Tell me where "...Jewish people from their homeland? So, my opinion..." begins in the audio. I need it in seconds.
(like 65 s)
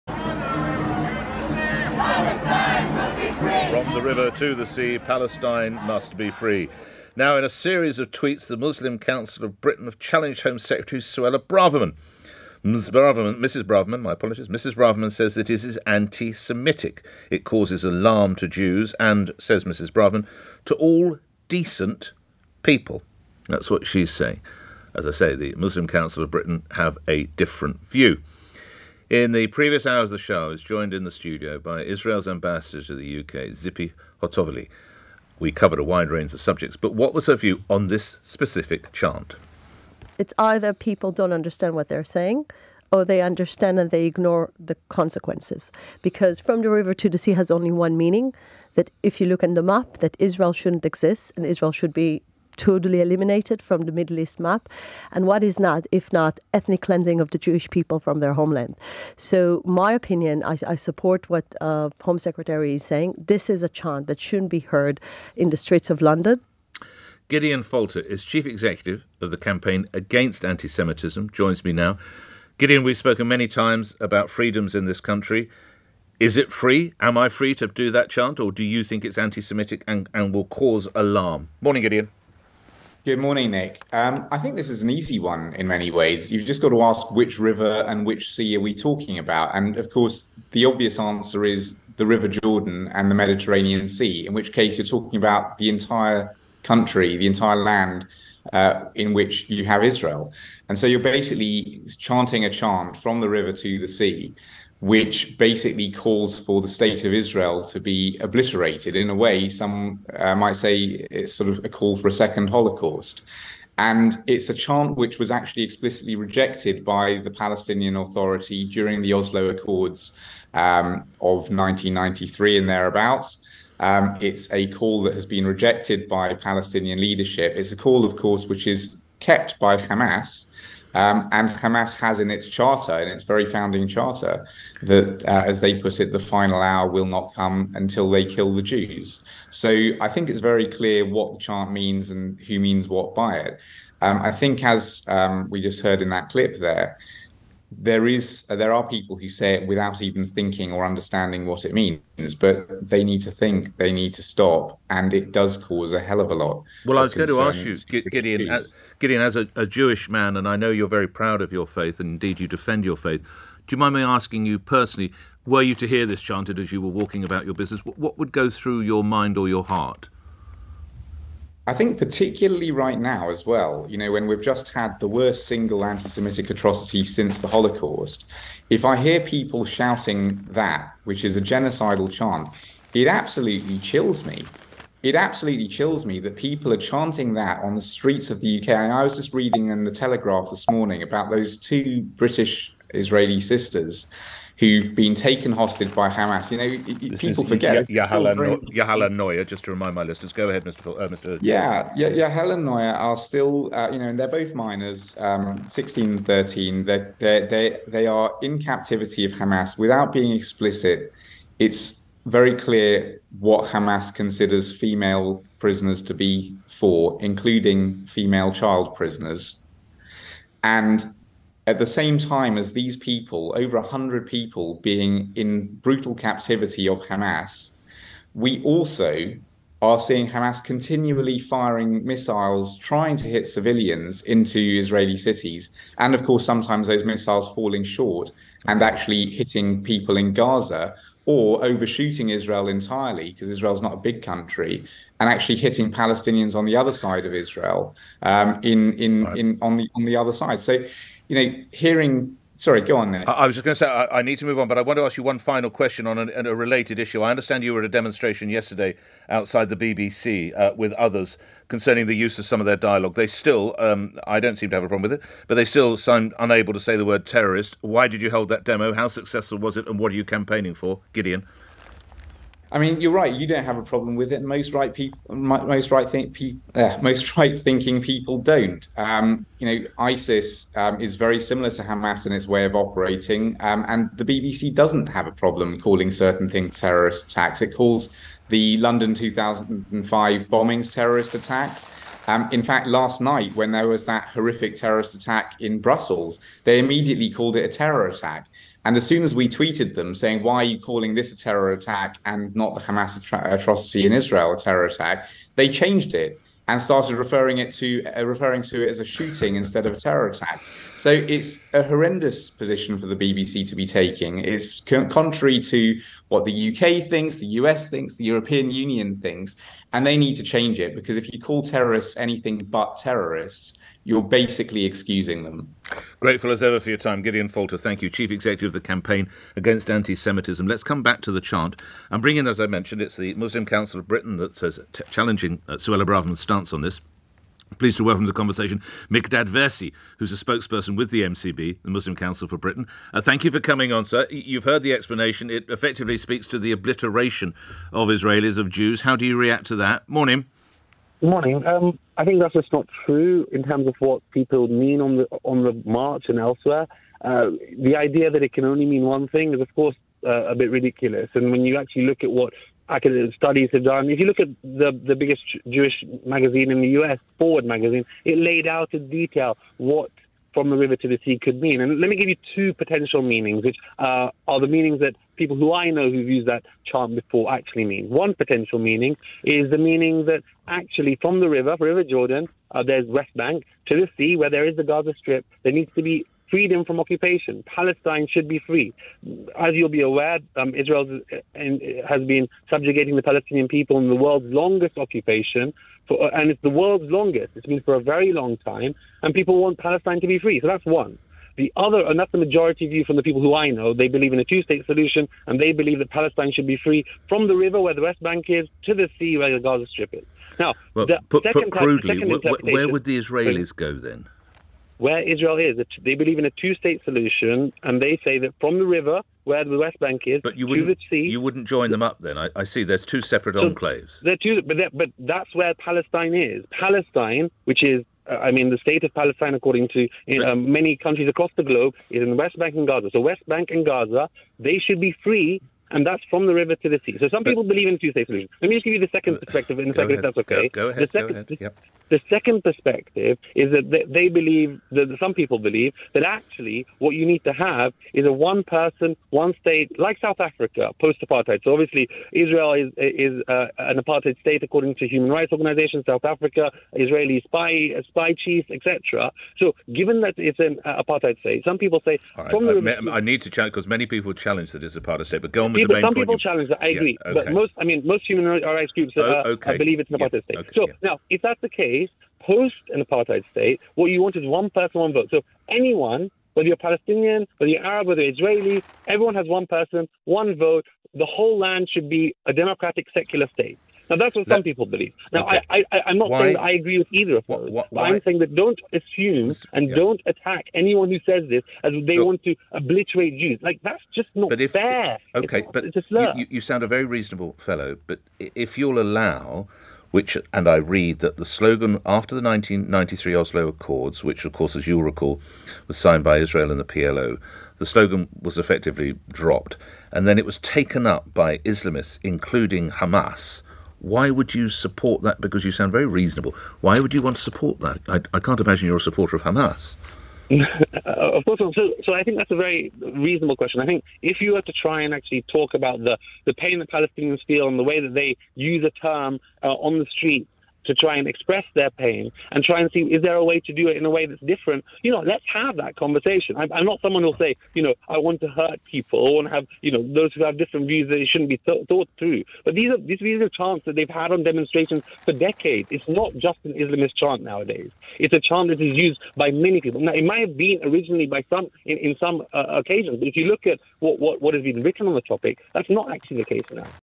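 57 s.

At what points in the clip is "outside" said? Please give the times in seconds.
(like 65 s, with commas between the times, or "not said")
259 s.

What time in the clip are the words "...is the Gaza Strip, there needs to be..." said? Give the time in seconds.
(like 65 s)
384 s.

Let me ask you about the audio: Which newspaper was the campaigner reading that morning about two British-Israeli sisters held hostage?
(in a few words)
The Telegraph.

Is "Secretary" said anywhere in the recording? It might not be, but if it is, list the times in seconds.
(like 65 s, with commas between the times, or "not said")
10 s, 62 s.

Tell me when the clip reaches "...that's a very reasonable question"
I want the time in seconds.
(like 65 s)
522 s.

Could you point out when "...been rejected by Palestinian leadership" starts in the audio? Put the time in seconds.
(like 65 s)
125 s.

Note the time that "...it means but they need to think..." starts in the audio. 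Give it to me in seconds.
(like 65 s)
151 s.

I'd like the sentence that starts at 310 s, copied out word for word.
So it's a horrendous position for the BBC to be taking.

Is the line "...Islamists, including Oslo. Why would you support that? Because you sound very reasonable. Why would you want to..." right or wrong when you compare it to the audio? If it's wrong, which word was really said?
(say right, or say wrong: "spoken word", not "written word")
wrong: "Hamas", not "Oslo".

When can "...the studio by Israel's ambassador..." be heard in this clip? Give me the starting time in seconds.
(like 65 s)
31 s.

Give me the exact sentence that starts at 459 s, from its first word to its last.
So given that it's an uh, apartheid state, some people say.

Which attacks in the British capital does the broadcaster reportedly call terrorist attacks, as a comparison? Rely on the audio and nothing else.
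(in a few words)
London 2005 bombings.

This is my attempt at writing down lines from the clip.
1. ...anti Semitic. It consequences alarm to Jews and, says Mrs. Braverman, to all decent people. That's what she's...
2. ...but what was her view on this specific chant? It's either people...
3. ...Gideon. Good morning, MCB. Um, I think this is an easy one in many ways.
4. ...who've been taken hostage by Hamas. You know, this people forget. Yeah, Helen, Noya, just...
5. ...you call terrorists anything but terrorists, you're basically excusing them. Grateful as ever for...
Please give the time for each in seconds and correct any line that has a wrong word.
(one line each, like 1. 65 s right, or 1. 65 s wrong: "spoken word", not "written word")
1. 15 s wrong: "causes", not "consequences"
2. 36 s right
3. 81 s wrong: "Nick", not "MCB"
4. 194 s right
5. 321 s right.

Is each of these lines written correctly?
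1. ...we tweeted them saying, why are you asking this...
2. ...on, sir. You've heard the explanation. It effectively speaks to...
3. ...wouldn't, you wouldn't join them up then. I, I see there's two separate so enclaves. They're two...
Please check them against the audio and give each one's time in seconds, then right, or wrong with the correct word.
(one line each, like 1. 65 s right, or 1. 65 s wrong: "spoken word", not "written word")
1. 299 s wrong: "calling", not "asking"
2. 343 s right
3. 420 s right.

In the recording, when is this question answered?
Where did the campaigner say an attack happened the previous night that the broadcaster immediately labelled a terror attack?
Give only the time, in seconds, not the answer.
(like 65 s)
295 s.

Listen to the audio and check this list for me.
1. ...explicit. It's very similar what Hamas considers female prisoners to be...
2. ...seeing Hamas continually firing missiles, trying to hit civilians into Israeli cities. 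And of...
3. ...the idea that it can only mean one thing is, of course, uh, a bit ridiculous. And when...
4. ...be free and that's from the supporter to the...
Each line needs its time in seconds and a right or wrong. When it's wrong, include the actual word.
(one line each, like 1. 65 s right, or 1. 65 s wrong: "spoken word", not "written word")
1. 210 s wrong: "clear", not "similar"
2. 229 s right
3. 357 s right
4. 435 s wrong: "river", not "supporter".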